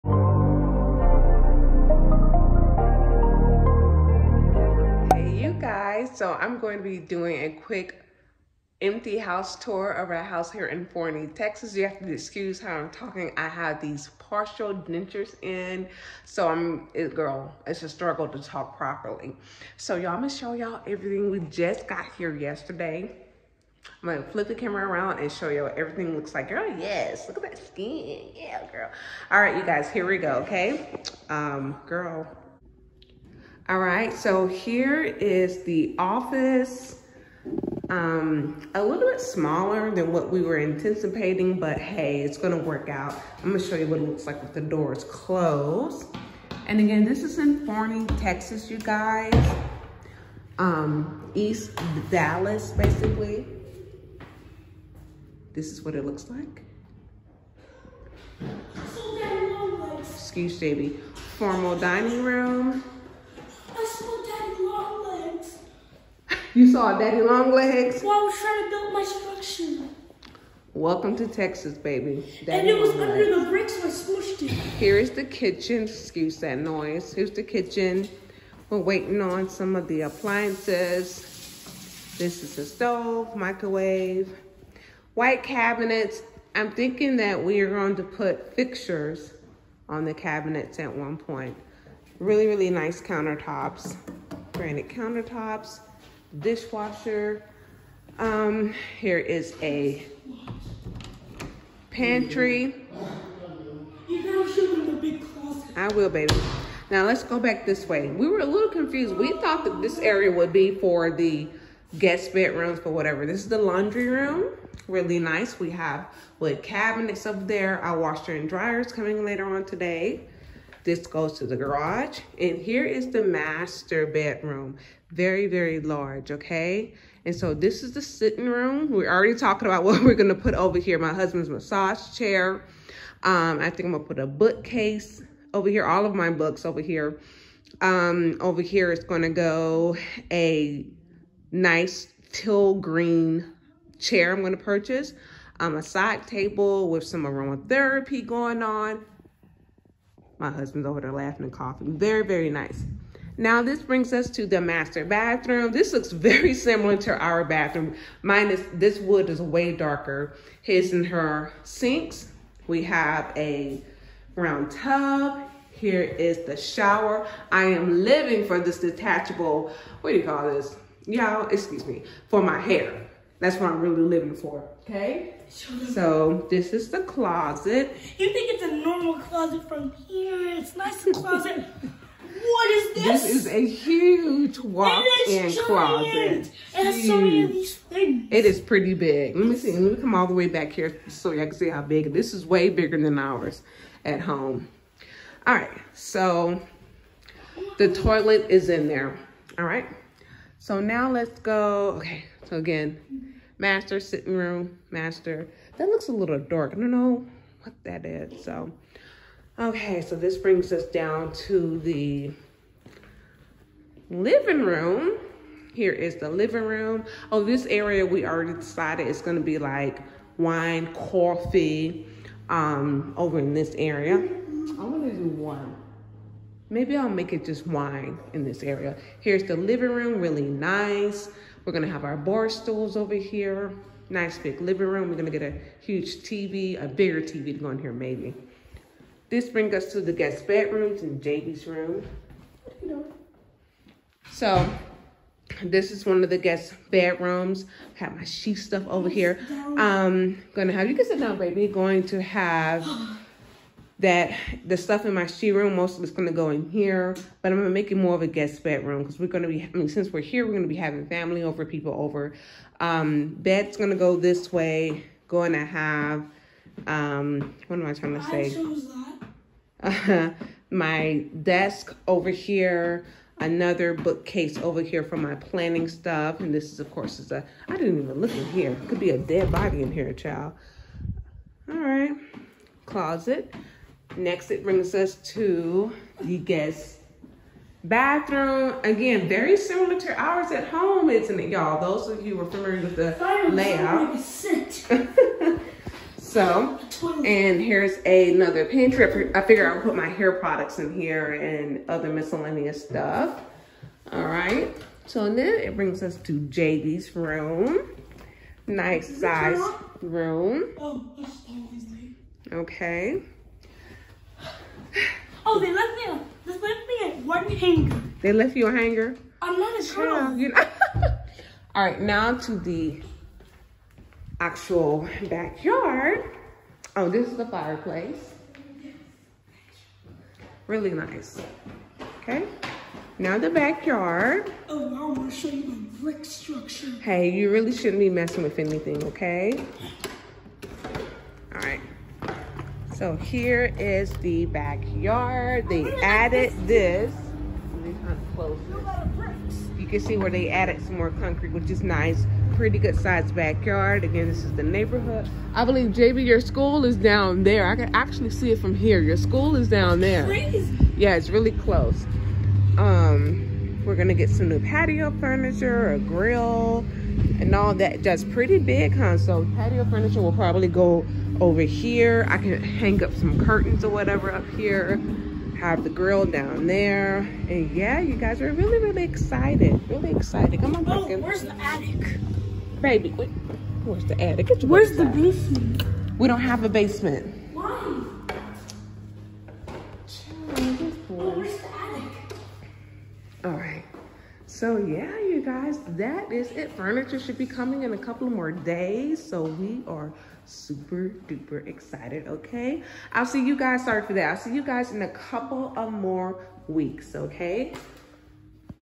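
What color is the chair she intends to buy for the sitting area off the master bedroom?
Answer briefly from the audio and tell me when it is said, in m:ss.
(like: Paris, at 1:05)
Teal green, at 2:22.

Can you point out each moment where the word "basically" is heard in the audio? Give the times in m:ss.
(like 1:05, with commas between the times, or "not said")
0:52.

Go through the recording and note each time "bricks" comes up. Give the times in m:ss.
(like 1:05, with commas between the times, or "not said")
1:13, 5:35.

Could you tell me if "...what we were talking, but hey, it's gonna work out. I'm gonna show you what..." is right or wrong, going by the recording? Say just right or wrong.
wrong.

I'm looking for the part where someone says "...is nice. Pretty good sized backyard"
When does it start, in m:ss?
5:51.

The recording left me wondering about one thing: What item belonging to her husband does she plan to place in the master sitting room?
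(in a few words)
Massage chair.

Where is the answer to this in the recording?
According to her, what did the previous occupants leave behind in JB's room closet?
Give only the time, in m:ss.
5:17.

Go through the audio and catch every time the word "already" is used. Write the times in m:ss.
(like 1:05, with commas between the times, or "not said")
2:09, 3:38.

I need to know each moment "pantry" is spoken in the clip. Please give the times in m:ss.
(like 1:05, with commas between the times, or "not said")
1:41, 4:58.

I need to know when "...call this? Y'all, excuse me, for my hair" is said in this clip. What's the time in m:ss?
2:50.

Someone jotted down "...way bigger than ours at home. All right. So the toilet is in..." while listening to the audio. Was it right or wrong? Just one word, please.
right.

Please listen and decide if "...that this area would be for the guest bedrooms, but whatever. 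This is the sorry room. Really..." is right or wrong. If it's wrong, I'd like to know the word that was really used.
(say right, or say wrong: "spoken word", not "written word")
wrong: "laundry", not "sorry".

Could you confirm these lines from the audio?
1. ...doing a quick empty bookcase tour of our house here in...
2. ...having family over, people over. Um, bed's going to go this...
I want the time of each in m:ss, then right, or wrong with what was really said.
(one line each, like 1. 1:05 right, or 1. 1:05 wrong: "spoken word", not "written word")
1. 0:06 wrong: "house", not "bookcase"
2. 4:20 right.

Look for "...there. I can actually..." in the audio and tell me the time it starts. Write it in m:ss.
5:57.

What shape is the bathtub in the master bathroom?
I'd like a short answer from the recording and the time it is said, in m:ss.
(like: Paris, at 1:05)
Round, at 2:44.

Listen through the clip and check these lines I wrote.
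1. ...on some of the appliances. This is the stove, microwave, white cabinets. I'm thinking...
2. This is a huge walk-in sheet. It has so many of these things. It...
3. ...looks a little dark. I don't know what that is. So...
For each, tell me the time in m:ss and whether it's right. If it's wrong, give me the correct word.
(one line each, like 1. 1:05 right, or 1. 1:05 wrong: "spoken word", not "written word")
1. 1:19 right
2. 3:03 wrong: "closet", not "sheet"
3. 3:25 right.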